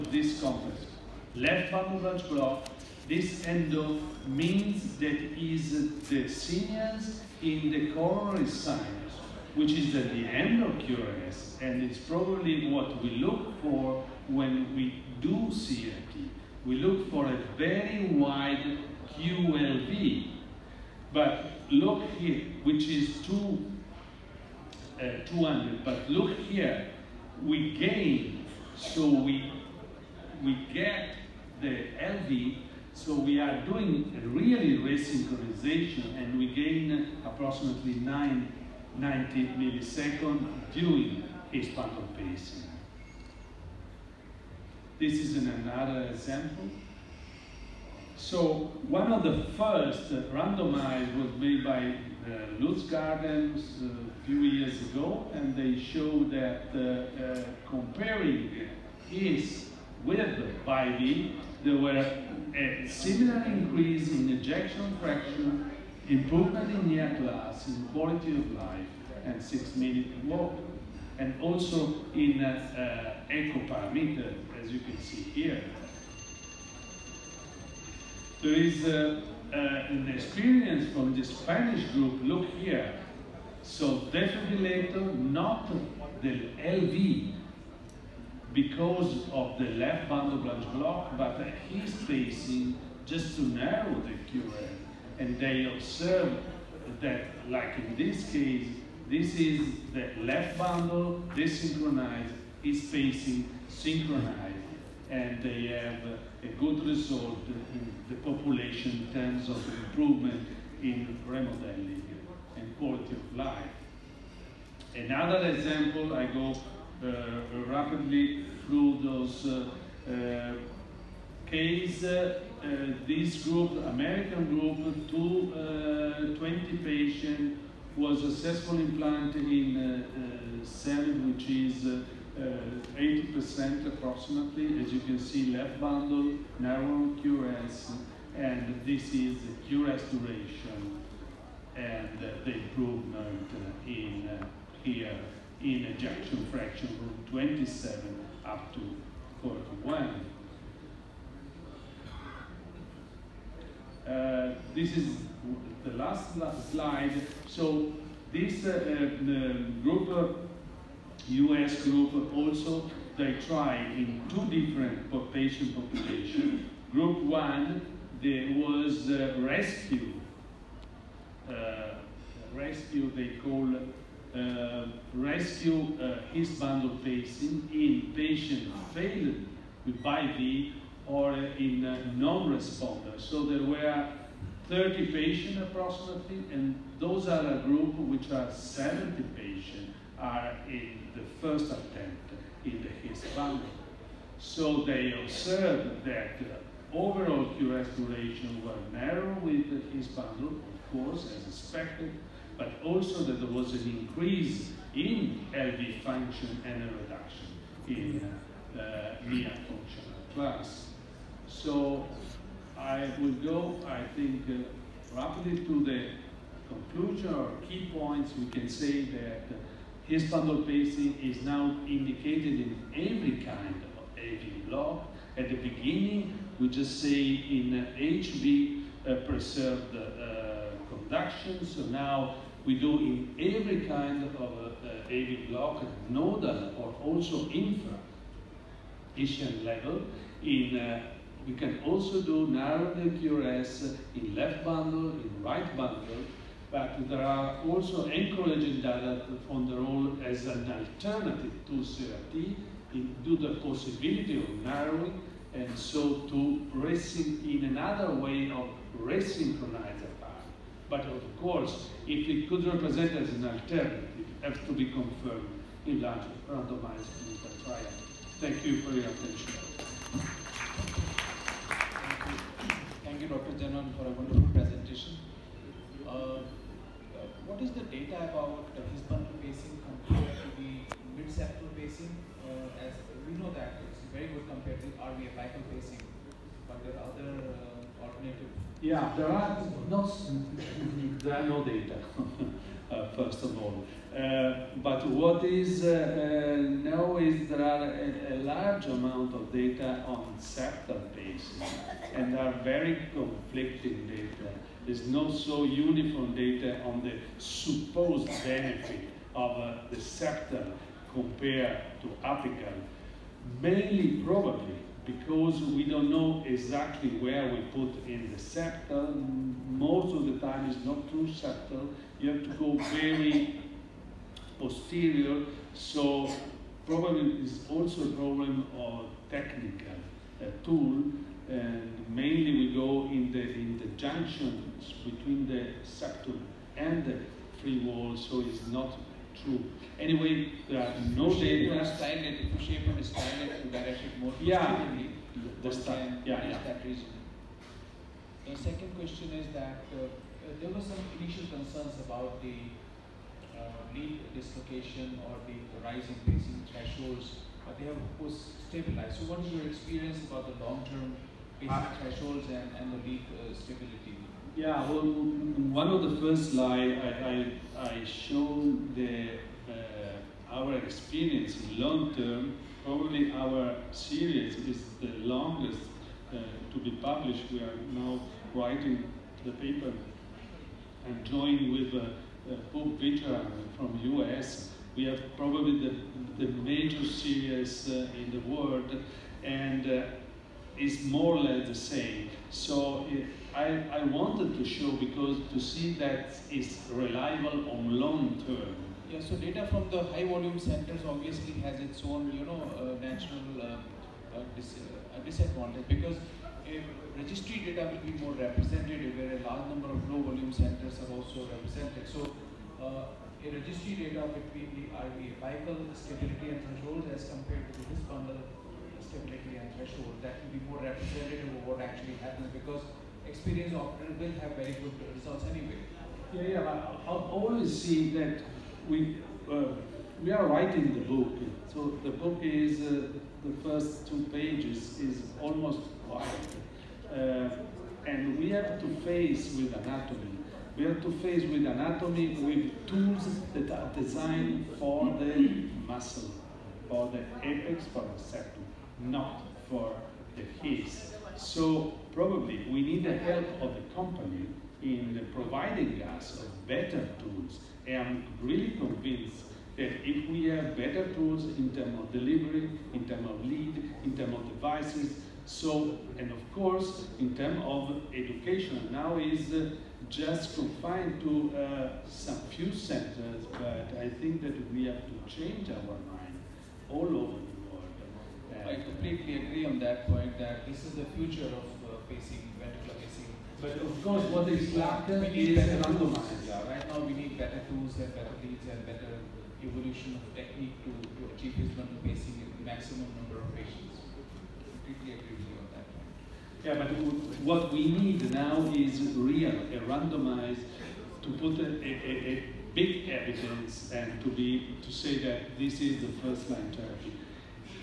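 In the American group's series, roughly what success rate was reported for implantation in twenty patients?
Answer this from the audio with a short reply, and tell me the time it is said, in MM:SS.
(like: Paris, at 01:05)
80%, at 02:12.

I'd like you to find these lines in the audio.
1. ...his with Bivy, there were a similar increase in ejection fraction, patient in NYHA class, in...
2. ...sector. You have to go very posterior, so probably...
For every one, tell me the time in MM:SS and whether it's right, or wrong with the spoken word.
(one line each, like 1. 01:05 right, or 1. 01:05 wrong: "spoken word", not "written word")
1. 00:59 wrong: "improvement", not "patient"
2. 05:21 right.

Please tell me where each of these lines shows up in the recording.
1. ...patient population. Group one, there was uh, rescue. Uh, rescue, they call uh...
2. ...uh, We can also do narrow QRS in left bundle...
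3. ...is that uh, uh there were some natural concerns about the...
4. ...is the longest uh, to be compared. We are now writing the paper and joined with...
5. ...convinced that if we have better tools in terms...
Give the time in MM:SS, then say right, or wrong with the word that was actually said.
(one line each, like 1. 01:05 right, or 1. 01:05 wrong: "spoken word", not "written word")
1. 02:45 right
2. 04:00 right
3. 05:49 wrong: "initial", not "natural"
4. 06:14 wrong: "published", not "compared"
5. 07:38 right.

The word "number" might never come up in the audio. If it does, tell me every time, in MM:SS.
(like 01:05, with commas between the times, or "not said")
06:49, 08:13.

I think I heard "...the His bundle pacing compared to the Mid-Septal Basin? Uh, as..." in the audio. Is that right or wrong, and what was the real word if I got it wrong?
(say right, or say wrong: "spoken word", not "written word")
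right.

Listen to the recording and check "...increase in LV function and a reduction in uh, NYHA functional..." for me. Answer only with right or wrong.
right.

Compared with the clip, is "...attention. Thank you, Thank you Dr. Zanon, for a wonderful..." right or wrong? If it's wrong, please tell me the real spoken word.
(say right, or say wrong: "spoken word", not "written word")
right.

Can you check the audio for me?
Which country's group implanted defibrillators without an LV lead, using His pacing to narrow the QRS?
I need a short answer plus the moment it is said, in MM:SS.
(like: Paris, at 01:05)
Spanish, at 01:21.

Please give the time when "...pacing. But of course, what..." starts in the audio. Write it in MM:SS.
08:02.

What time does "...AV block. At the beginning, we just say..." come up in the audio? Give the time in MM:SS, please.
03:44.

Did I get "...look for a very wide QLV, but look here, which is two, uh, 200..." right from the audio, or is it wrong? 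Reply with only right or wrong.
right.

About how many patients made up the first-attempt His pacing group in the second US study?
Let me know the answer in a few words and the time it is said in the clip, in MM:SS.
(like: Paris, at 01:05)
70, at 03:08.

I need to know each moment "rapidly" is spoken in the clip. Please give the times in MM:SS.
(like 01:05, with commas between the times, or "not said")
01:57, 03:35.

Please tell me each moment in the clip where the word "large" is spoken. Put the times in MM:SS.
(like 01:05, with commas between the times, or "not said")
04:26, 04:58, 06:49.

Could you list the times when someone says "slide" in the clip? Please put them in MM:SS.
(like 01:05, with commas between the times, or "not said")
02:36, 06:06.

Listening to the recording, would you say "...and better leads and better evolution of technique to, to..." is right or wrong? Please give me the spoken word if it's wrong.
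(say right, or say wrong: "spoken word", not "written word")
right.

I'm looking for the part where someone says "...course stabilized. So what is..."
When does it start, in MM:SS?
05:58.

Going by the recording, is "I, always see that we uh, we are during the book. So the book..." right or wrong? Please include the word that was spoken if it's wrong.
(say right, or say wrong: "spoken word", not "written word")
wrong: "writing", not "during".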